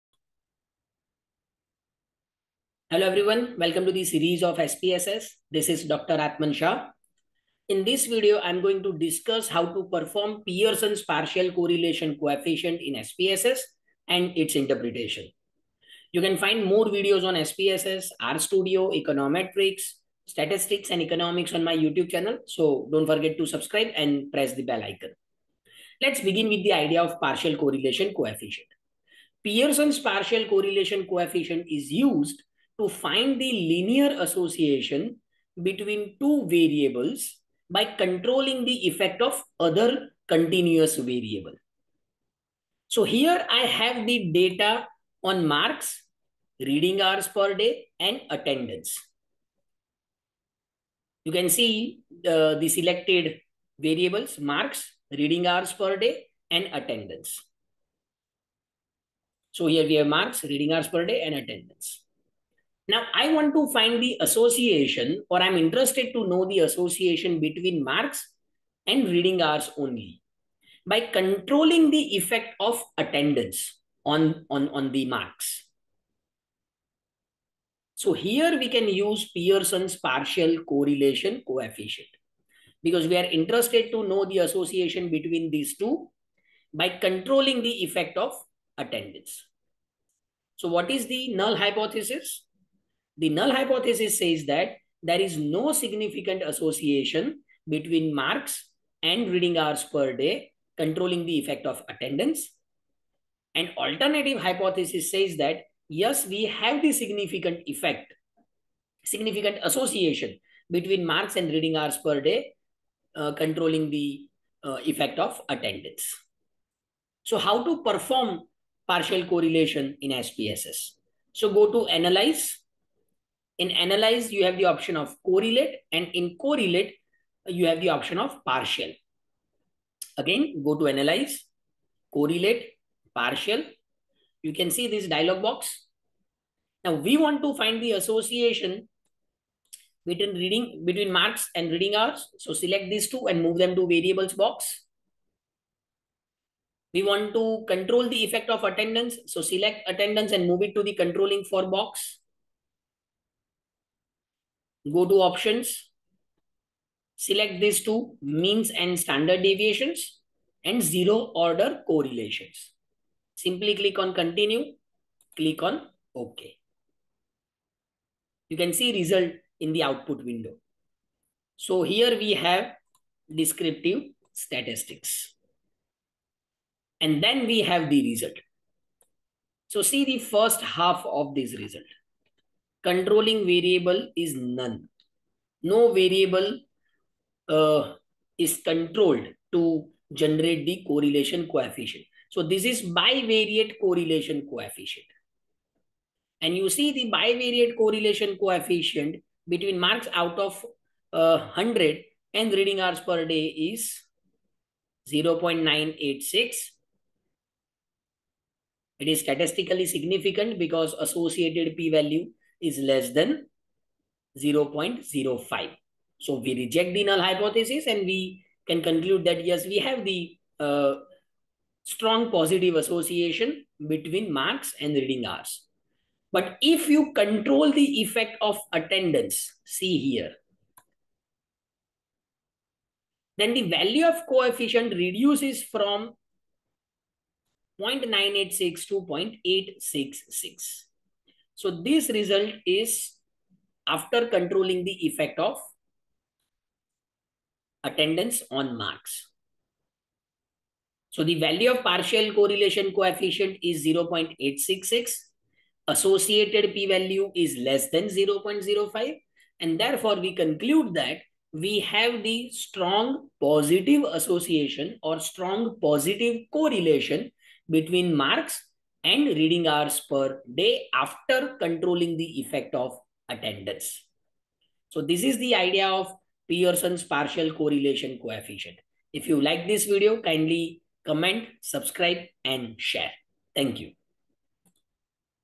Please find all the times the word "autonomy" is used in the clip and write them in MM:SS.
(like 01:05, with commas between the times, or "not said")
not said.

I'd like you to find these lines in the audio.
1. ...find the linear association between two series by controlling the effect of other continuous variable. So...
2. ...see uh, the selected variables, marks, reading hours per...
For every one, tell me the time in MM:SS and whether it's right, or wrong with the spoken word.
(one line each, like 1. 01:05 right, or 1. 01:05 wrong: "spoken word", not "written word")
1. 00:32 wrong: "variables", not "series"
2. 00:51 right.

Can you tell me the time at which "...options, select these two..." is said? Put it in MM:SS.
02:35.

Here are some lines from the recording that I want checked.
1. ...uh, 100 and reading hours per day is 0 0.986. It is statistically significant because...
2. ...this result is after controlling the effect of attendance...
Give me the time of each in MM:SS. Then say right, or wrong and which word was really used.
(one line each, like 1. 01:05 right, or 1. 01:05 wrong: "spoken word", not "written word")
1. 03:21 right
2. 04:01 right.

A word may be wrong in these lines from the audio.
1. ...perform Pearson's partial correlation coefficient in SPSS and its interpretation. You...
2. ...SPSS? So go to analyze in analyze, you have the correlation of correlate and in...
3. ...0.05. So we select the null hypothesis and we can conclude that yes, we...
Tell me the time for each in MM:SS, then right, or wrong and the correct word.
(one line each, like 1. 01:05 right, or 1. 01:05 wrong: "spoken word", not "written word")
1. 00:09 right
2. 02:00 wrong: "option", not "correlation"
3. 03:34 wrong: "reject", not "select".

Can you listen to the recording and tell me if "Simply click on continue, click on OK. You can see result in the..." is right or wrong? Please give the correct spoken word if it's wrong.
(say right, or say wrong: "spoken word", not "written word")
right.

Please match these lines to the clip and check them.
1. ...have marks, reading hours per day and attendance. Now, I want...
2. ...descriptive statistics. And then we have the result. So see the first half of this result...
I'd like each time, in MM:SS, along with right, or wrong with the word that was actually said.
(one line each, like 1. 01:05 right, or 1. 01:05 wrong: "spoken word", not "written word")
1. 00:59 right
2. 02:53 right.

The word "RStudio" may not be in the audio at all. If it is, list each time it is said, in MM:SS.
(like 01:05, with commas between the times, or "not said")
00:18.